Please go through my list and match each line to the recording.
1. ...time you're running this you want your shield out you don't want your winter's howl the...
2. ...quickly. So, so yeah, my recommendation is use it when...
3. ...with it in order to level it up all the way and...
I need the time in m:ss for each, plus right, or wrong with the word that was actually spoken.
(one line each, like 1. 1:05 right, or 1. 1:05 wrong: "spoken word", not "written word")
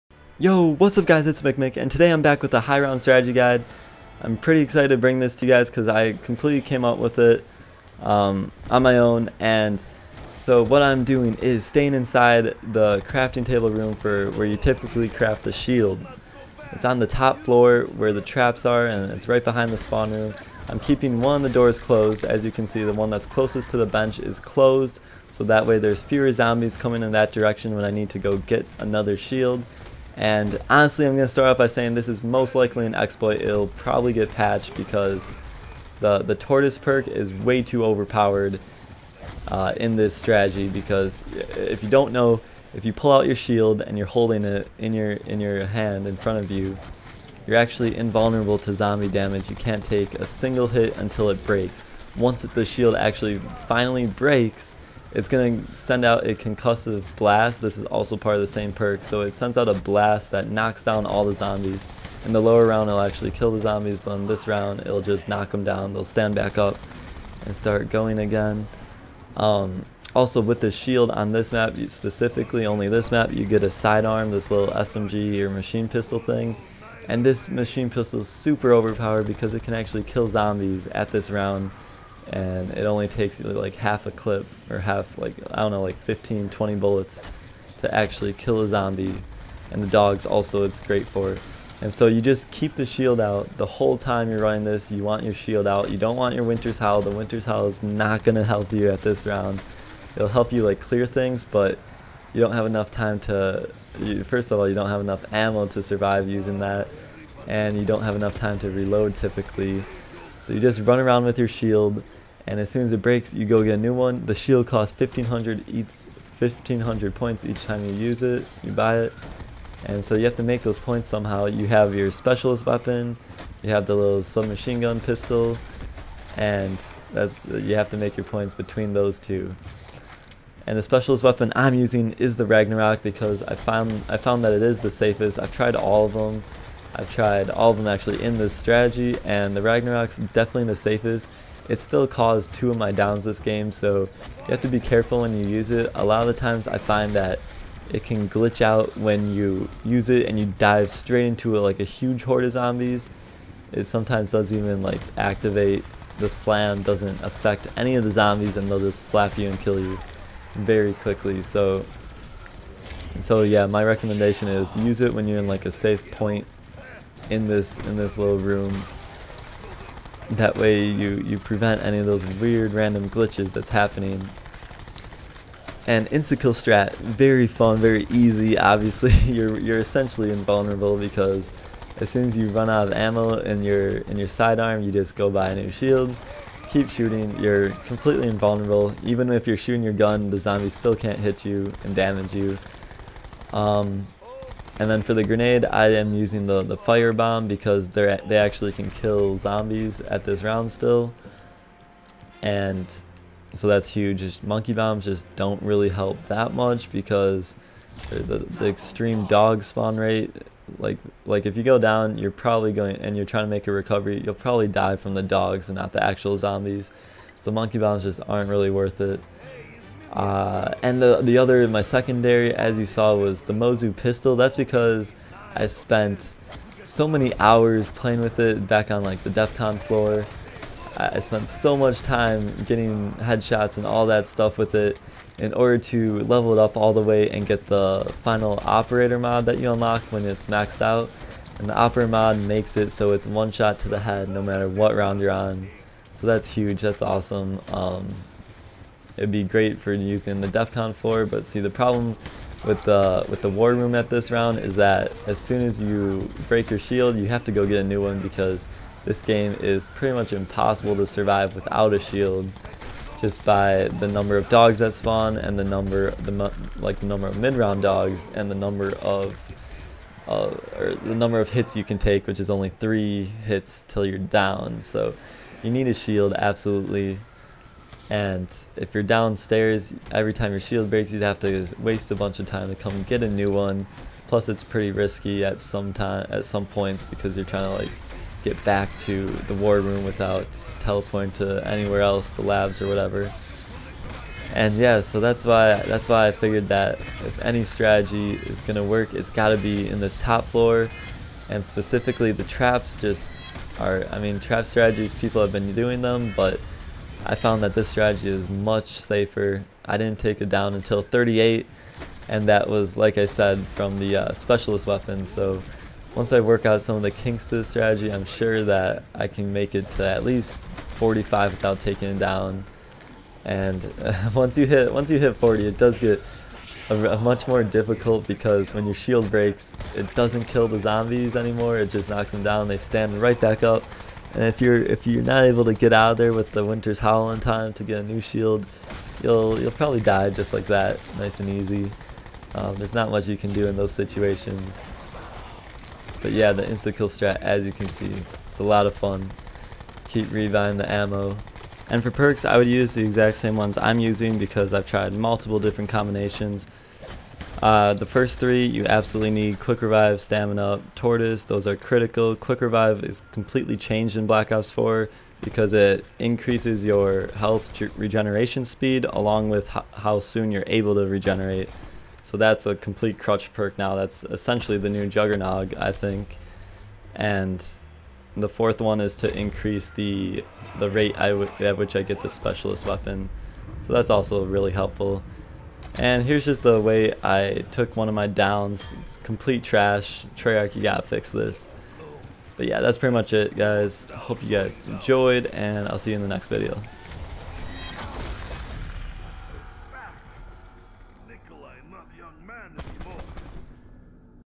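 1. 1:33 right
2. 2:40 right
3. 3:54 right.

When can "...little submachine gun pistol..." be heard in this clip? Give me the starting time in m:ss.
2:03.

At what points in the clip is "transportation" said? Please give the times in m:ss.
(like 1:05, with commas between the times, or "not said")
not said.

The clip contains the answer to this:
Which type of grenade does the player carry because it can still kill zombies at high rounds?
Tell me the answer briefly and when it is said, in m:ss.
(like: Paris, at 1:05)
fire bomb, at 3:16.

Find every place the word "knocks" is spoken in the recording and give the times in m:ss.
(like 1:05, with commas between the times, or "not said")
1:00, 1:05, 5:32.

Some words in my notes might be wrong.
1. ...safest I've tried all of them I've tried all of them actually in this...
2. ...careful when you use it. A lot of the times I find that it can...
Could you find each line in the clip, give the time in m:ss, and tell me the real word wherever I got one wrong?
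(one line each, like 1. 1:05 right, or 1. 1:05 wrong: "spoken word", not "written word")
1. 2:14 right
2. 2:24 right.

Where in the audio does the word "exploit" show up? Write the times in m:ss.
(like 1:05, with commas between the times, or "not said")
0:32.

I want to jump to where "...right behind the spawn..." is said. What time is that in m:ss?
0:19.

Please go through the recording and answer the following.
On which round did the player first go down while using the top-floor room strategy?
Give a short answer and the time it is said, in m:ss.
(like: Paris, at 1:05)
38, at 5:11.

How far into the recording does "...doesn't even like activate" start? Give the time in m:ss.
2:34.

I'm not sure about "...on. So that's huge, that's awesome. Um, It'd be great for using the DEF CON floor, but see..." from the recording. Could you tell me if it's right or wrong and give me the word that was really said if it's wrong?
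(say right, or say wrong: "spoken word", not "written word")
right.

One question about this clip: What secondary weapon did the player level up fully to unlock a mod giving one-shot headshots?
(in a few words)
Mozu pistol.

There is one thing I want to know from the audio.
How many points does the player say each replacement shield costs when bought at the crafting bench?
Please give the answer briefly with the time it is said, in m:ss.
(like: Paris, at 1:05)
1500, at 1:56.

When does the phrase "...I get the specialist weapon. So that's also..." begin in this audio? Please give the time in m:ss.
6:21.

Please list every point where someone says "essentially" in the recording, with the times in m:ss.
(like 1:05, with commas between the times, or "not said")
2:59, 6:14.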